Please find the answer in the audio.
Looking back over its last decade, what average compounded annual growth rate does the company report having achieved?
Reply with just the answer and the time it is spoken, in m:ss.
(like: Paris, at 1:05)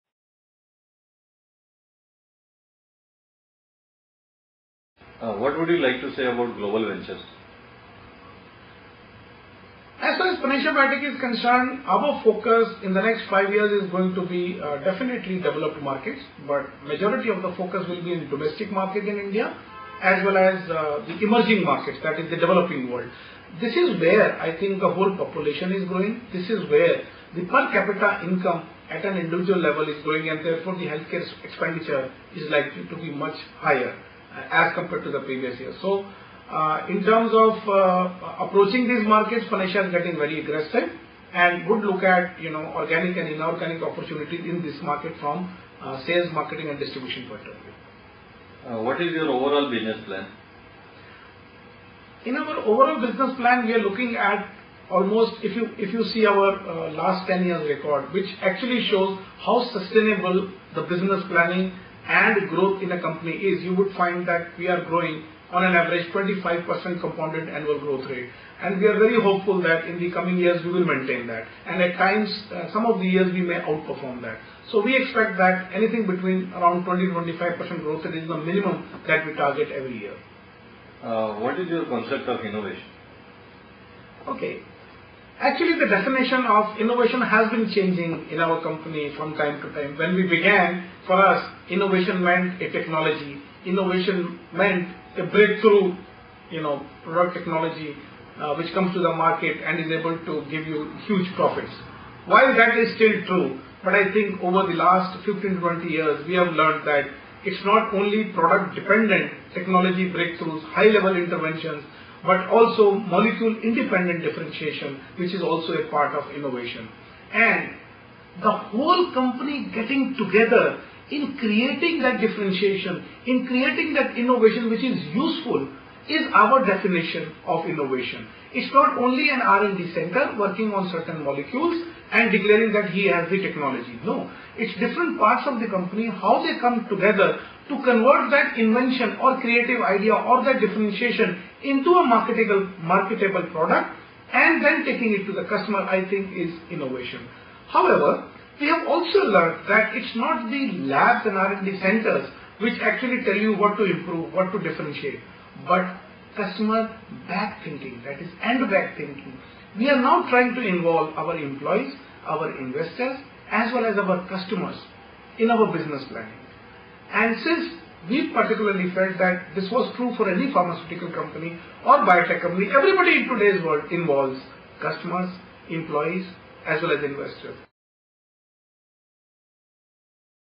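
25%, at 1:06.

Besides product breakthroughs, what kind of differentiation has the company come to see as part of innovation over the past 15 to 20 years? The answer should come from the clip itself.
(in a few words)
molecule-independent differentiation.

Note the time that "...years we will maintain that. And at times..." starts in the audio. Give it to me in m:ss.
1:10.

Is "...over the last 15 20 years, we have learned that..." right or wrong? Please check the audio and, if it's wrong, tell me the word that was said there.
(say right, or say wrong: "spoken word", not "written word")
right.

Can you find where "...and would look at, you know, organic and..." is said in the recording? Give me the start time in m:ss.
0:41.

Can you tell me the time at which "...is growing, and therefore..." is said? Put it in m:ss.
0:29.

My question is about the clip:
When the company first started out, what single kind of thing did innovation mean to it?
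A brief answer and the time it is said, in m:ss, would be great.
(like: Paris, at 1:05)
a technology, at 1:32.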